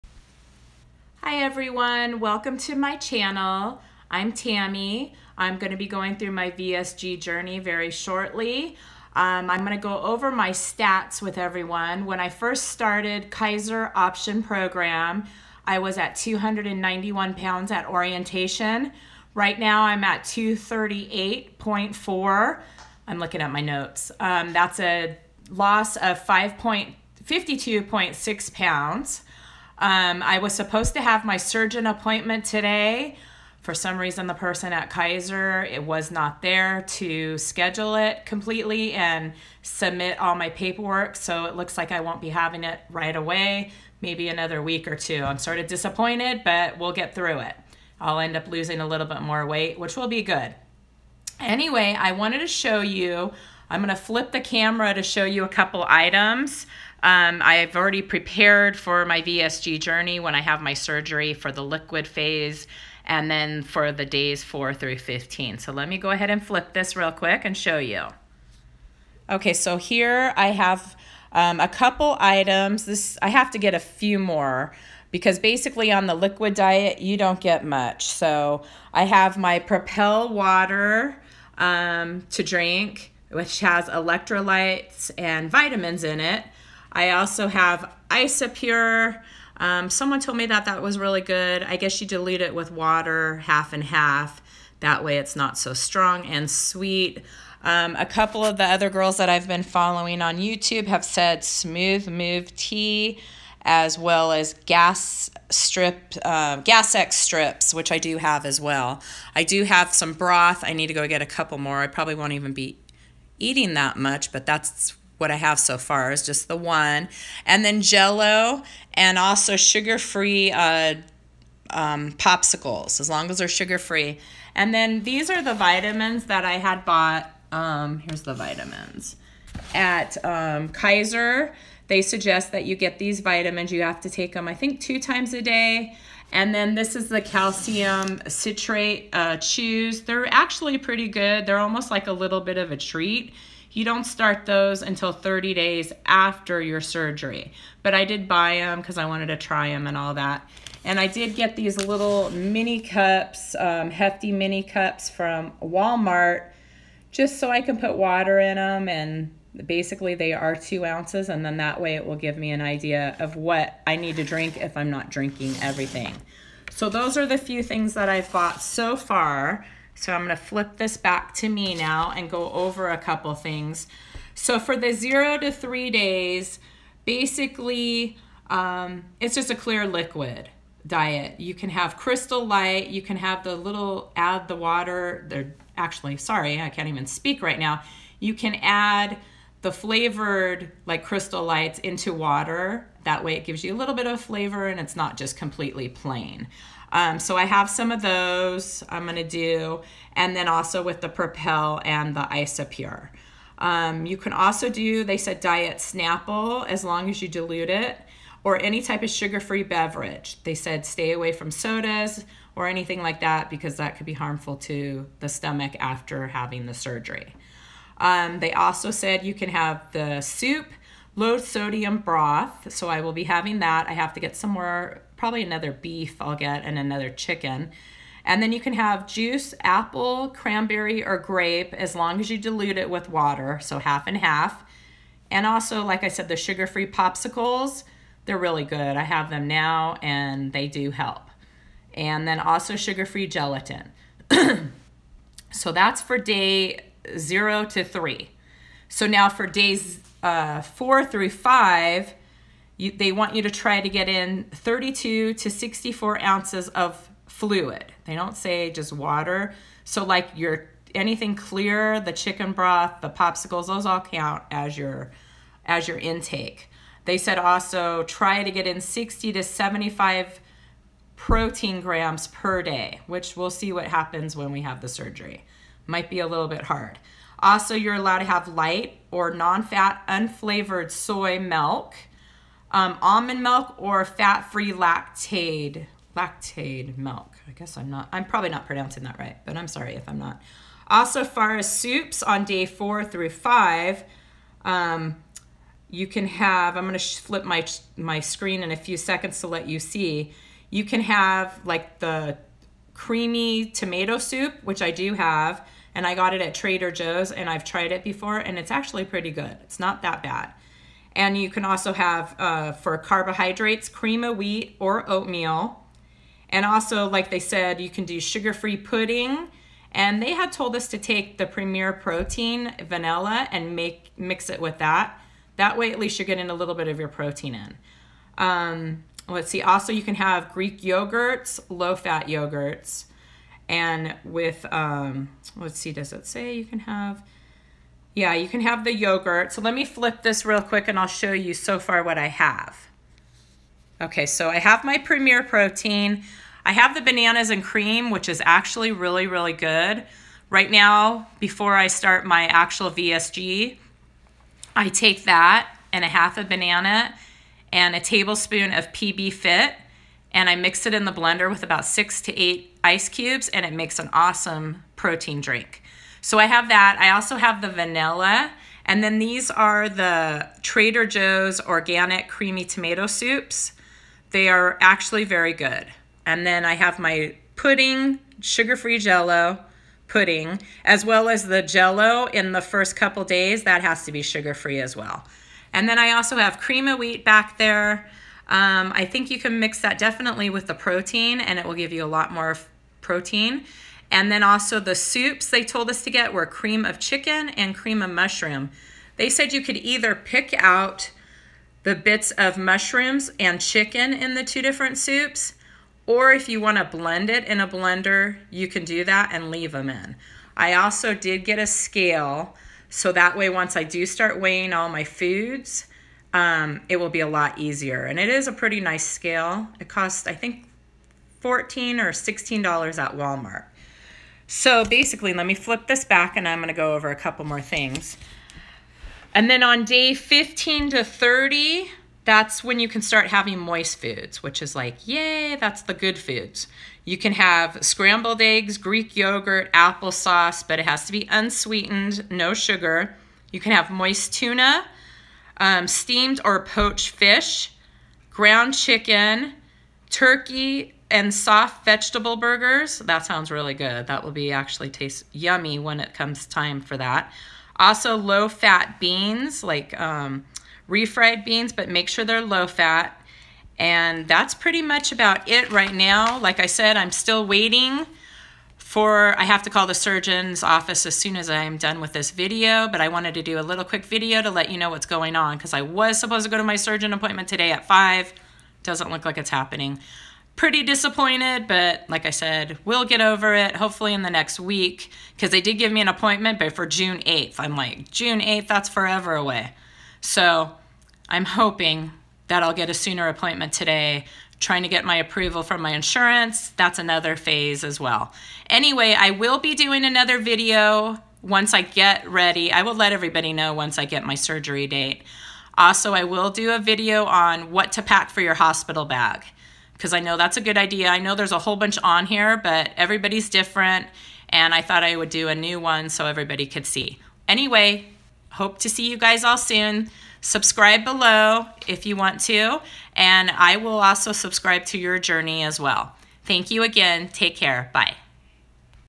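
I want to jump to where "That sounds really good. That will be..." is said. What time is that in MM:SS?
07:32.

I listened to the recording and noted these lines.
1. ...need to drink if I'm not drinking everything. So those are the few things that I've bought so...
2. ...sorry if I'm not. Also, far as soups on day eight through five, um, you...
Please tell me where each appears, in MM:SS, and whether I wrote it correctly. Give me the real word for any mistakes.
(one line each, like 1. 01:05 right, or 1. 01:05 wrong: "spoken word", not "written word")
1. 02:43 right
2. 04:49 wrong: "four", not "eight".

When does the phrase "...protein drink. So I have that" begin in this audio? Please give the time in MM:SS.
06:04.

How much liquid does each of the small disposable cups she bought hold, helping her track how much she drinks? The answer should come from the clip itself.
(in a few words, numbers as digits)
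2 ounces.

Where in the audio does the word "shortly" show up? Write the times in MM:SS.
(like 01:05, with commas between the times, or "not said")
00:07.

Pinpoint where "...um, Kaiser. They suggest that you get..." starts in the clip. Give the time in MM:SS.
02:10.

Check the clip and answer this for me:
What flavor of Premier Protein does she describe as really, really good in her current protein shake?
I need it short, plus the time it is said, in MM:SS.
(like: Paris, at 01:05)
Bananas and cream, at 05:47.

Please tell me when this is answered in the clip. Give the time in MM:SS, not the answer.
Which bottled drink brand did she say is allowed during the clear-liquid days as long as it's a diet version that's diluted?
03:25.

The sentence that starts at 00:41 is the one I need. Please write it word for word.
So it looks like I won't be having it right away.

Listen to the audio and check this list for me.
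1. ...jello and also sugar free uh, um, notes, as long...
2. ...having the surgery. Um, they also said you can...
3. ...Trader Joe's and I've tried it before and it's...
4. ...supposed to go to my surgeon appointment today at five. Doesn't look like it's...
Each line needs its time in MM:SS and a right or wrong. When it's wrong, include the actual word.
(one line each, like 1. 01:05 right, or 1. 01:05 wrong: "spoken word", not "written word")
1. 01:57 wrong: "popsicles", not "notes"
2. 03:36 right
3. 05:06 right
4. 07:56 right.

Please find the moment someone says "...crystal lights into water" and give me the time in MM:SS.
03:11.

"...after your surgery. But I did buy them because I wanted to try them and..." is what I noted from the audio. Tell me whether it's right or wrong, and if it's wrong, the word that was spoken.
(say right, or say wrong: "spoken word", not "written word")
right.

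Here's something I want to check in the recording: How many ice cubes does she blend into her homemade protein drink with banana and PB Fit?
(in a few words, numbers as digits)
6 to 8.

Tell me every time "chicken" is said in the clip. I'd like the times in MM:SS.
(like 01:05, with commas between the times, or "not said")
03:47, 04:22, 06:36, 06:43, 07:28.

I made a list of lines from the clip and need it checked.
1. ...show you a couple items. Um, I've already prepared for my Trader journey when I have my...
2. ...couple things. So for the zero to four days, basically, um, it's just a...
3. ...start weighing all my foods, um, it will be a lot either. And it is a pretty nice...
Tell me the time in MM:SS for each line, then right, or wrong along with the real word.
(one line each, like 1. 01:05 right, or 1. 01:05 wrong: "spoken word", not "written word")
1. 00:55 wrong: "VSG", not "Trader"
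2. 02:52 wrong: "three", not "four"
3. 06:54 wrong: "easier", not "either".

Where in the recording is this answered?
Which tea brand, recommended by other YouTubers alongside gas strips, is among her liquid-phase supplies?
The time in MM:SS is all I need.
01:41.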